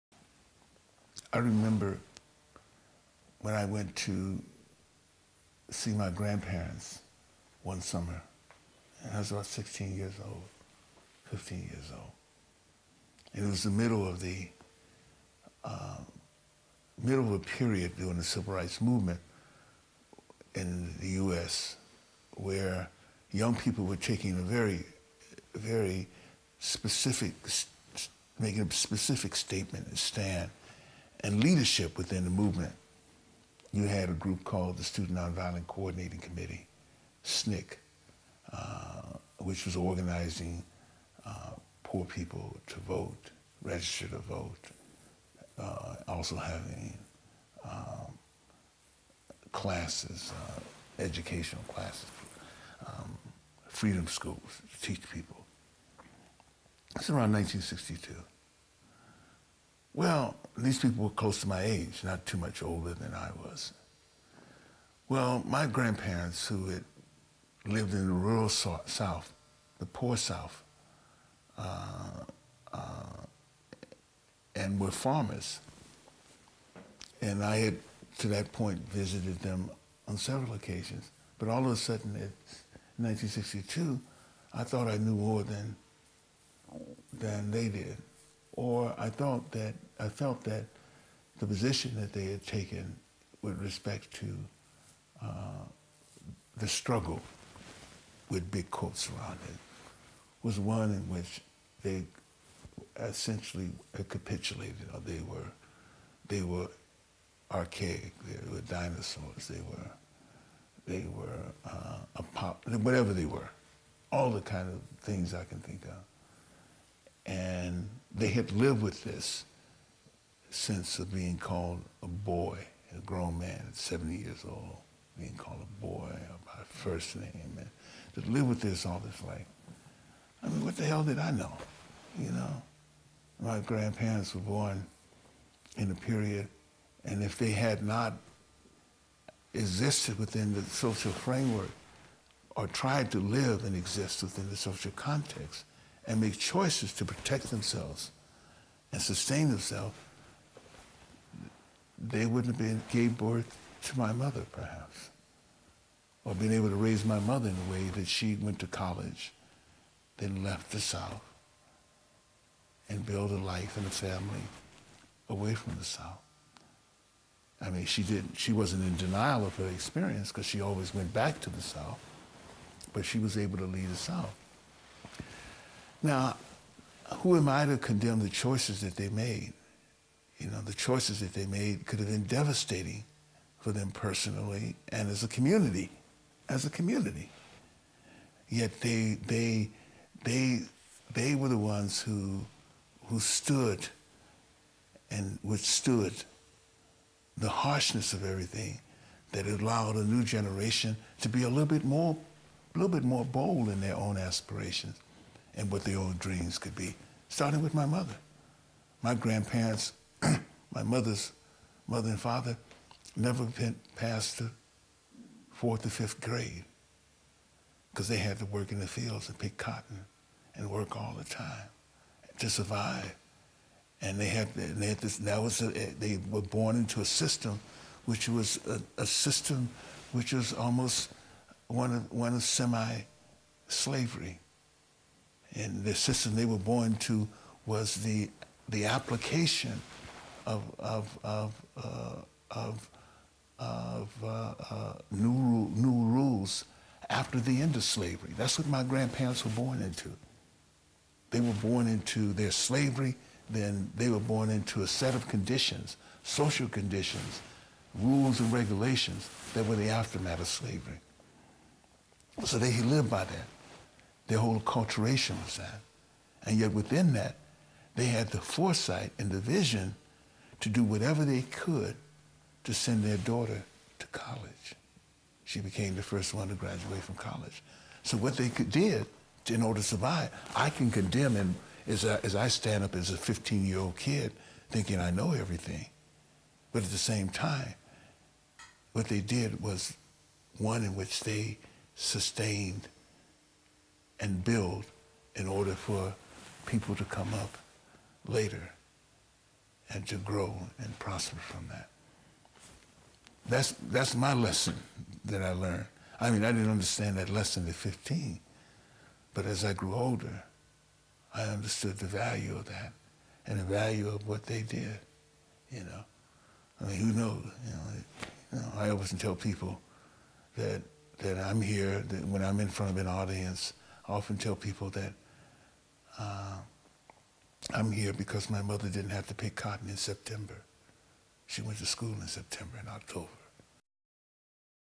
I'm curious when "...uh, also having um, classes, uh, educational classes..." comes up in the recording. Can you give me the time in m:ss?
0:45.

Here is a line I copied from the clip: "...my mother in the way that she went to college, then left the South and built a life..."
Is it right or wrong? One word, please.
right.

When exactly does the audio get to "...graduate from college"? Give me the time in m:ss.
4:36.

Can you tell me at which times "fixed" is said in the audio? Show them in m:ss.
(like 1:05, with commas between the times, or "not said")
not said.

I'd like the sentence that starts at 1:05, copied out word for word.
Well, my grandparents, who had lived in the rural South, the poor South, uh, uh, and were farmers.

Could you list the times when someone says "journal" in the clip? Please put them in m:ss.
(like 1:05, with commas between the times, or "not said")
not said.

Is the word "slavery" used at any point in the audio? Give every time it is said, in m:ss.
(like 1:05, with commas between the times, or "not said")
3:52, 4:07, 4:12, 4:20.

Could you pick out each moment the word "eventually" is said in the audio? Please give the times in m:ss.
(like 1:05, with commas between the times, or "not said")
not said.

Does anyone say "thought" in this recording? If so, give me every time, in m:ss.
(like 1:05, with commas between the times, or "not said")
1:24, 1:29.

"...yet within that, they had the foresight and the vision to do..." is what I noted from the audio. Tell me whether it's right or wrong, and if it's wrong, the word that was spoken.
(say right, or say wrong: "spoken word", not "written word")
right.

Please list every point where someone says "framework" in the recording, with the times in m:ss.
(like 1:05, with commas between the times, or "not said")
2:21.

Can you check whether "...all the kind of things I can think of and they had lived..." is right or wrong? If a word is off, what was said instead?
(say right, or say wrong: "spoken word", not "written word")
right.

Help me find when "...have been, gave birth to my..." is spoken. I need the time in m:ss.
2:32.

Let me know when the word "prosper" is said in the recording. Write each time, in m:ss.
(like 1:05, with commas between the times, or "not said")
5:00.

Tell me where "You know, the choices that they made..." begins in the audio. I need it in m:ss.
3:00.